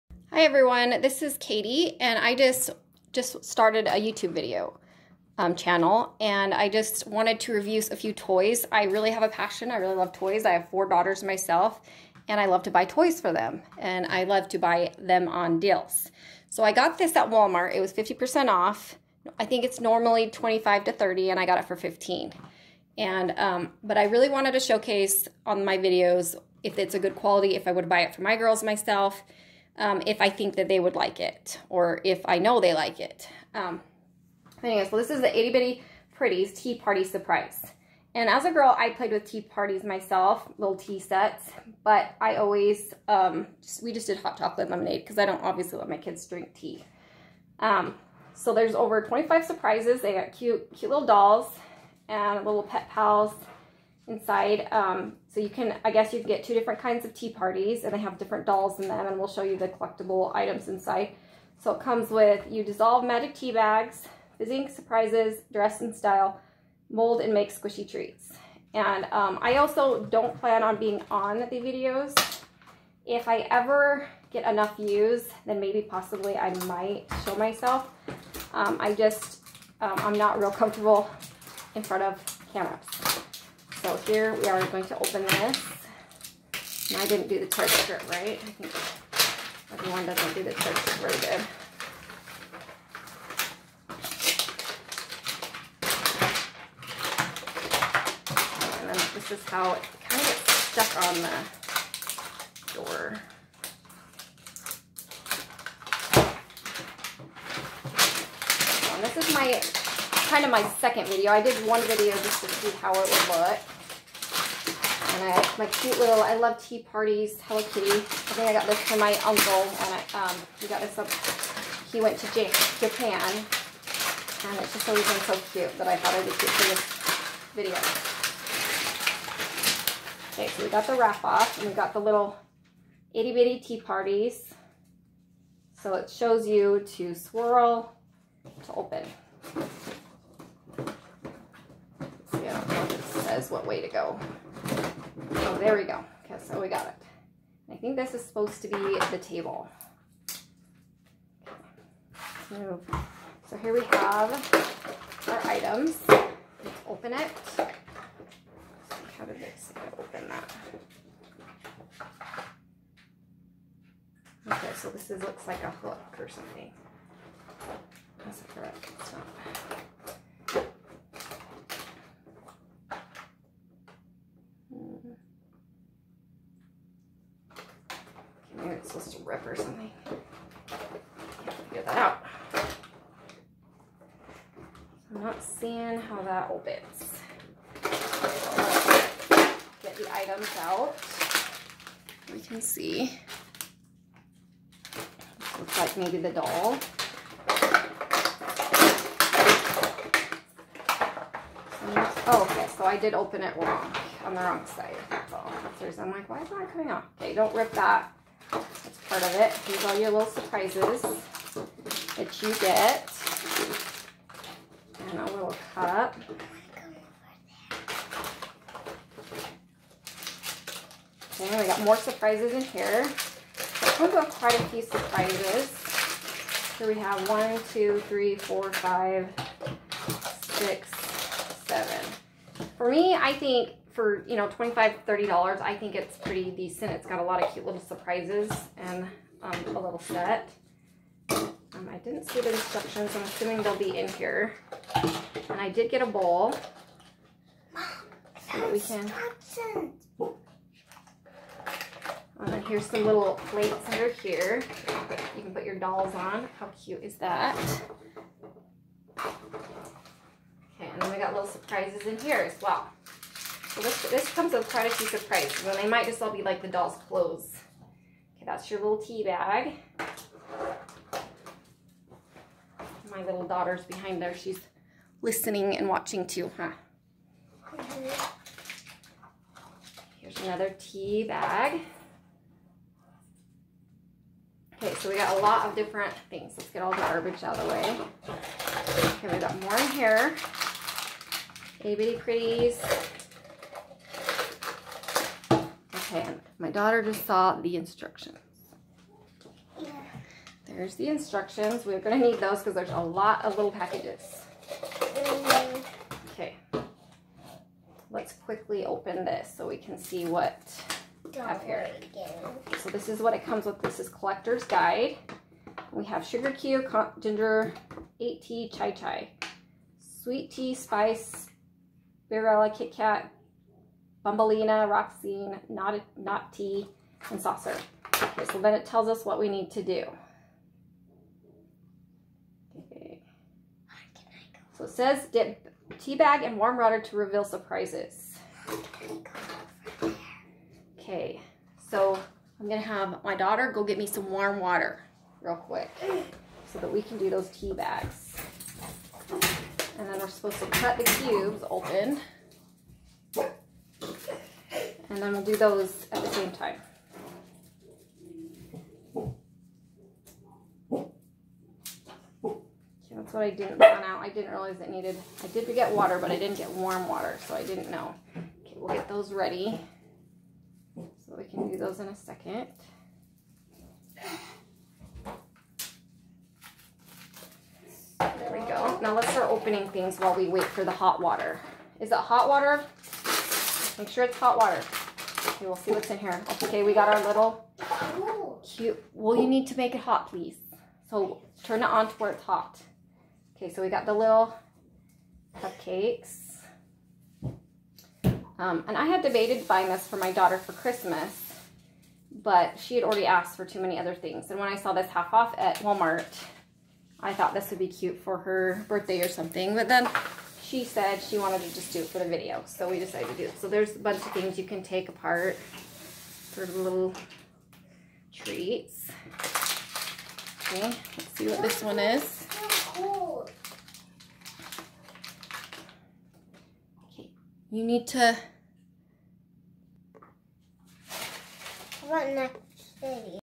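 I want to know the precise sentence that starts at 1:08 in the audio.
And um, I also don't plan on being on the videos.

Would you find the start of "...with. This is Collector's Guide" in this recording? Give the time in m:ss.
5:13.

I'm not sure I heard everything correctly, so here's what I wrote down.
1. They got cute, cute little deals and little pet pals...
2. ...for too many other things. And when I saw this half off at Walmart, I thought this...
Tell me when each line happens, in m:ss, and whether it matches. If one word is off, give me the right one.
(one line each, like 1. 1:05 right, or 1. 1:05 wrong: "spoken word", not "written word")
1. 0:50 wrong: "dolls", not "deals"
2. 6:43 right.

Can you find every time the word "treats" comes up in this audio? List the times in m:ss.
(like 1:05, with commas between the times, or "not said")
1:07, 6:58.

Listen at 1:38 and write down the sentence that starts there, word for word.
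And then this is how it kind of gets stuck on the door.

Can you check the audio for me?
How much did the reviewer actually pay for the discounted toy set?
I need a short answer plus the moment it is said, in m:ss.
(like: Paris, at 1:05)
15, at 0:21.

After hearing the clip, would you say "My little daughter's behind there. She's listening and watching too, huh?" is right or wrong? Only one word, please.
right.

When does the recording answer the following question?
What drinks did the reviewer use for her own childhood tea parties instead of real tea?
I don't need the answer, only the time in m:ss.
0:44.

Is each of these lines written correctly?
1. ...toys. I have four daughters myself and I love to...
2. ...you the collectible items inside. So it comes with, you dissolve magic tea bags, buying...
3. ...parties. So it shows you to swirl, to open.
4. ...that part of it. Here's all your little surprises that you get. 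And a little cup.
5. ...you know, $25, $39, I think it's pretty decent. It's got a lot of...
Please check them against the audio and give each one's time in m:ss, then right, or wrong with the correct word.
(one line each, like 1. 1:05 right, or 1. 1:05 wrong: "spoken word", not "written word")
1. 0:10 right
2. 0:59 wrong: "fizzing", not "buying"
3. 2:13 right
4. 3:27 right
5. 3:54 wrong: "30", not "39".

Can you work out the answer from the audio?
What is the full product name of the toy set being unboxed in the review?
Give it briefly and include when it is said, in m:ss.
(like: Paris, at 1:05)
Itty Bitty Prettys Tea Party Surprise, at 0:35.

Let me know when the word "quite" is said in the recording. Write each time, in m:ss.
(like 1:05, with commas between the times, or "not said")
3:44, 4:24.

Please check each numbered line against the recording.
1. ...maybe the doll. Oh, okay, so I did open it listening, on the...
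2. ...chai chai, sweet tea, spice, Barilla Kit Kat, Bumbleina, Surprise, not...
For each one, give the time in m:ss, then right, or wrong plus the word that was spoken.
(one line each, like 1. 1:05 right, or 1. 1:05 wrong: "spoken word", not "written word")
1. 3:15 wrong: "wrong", not "listening"
2. 5:18 wrong: "Roxine", not "Surprise".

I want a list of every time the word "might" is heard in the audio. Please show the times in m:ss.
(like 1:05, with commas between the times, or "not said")
1:16, 4:25.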